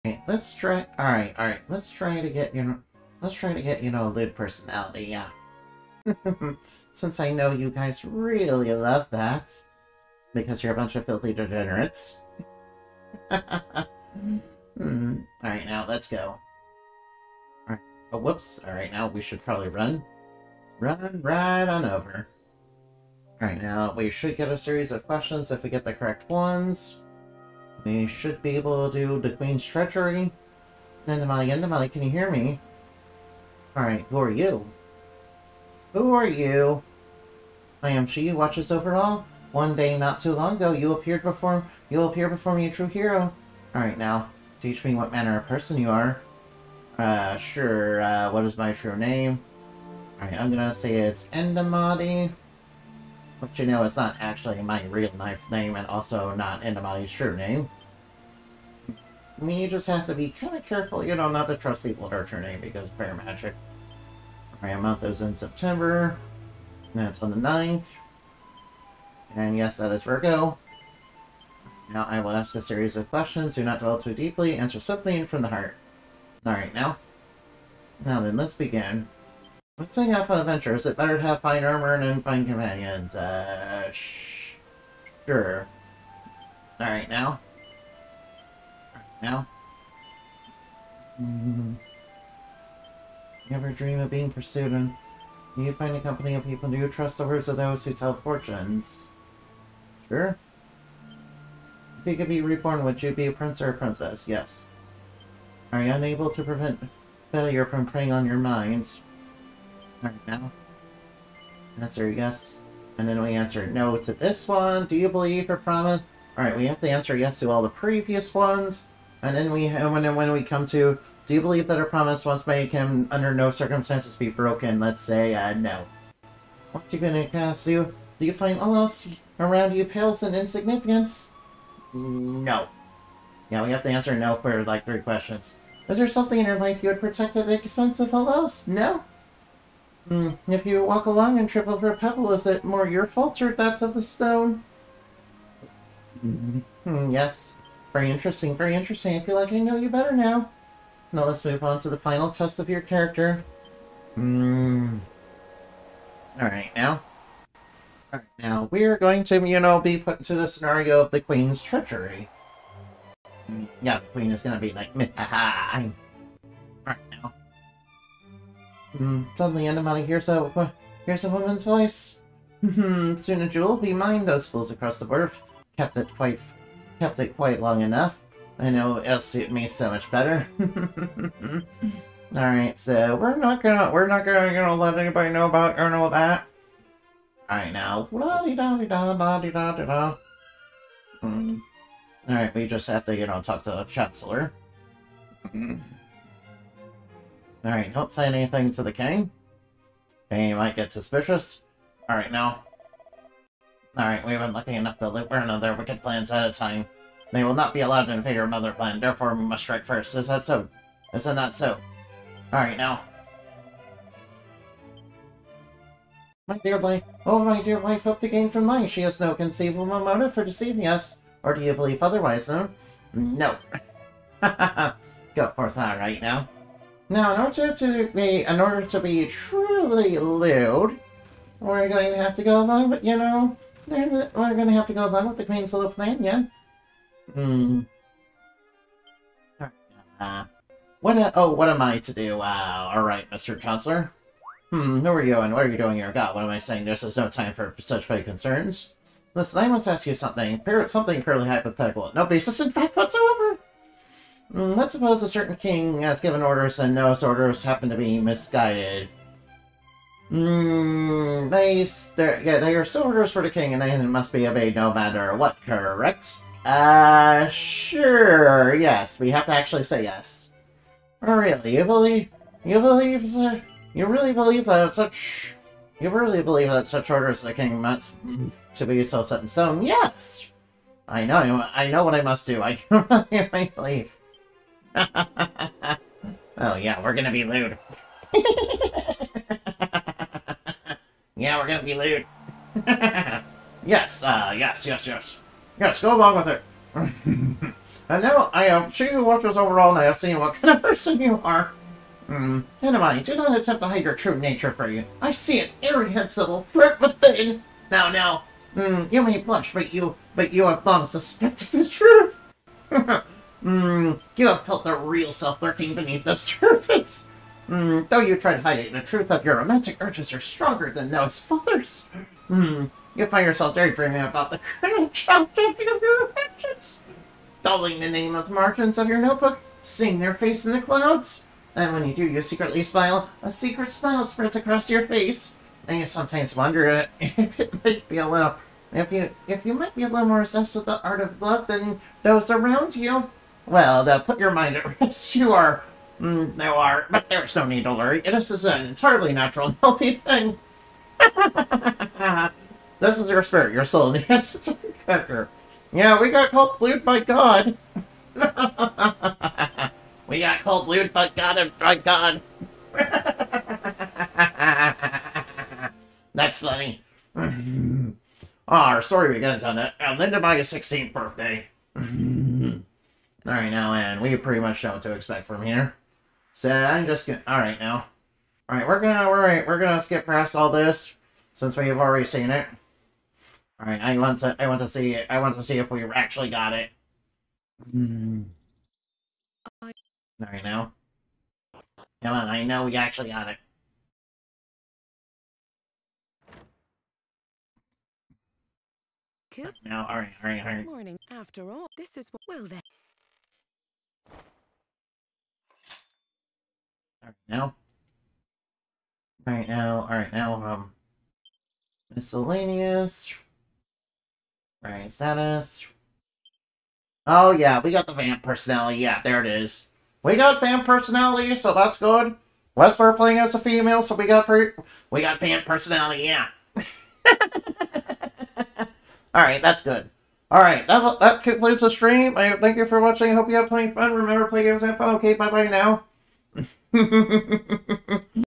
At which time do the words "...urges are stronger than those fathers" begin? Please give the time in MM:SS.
05:20.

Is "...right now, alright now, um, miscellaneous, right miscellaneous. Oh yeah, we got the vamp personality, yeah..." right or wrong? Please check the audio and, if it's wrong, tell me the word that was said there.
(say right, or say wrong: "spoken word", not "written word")
wrong: "status", not "miscellaneous".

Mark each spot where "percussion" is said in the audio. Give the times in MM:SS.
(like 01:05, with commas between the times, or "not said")
not said.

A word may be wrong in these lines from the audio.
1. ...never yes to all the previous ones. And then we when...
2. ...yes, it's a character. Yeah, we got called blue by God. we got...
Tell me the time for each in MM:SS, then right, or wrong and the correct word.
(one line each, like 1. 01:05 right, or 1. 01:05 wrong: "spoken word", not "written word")
1. 01:56 wrong: "answer", not "never"
2. 05:54 right.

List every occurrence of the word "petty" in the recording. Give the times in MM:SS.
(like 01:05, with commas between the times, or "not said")
04:08.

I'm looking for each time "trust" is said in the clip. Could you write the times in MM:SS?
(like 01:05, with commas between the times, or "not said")
01:01, 01:36.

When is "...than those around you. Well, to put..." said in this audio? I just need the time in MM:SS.
05:41.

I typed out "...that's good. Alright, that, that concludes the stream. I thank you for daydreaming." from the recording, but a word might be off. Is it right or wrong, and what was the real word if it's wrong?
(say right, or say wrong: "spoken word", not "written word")
wrong: "watching", not "daydreaming".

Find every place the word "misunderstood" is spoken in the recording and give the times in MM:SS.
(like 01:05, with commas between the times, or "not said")
not said.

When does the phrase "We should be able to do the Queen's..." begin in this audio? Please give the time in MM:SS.
00:27.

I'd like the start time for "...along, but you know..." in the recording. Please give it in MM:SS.
03:52.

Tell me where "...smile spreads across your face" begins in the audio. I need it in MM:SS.
05:33.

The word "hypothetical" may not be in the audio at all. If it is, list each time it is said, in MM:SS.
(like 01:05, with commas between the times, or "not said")
04:11.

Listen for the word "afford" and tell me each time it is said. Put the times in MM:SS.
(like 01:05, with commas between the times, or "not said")
not said.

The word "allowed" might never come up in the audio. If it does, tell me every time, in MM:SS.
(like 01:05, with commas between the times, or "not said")
03:27.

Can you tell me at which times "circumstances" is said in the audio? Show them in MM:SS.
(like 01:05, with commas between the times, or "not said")
02:03.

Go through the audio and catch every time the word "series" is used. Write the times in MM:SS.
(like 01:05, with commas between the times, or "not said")
00:24, 01:12.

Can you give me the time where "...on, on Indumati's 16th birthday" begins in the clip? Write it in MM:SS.
06:09.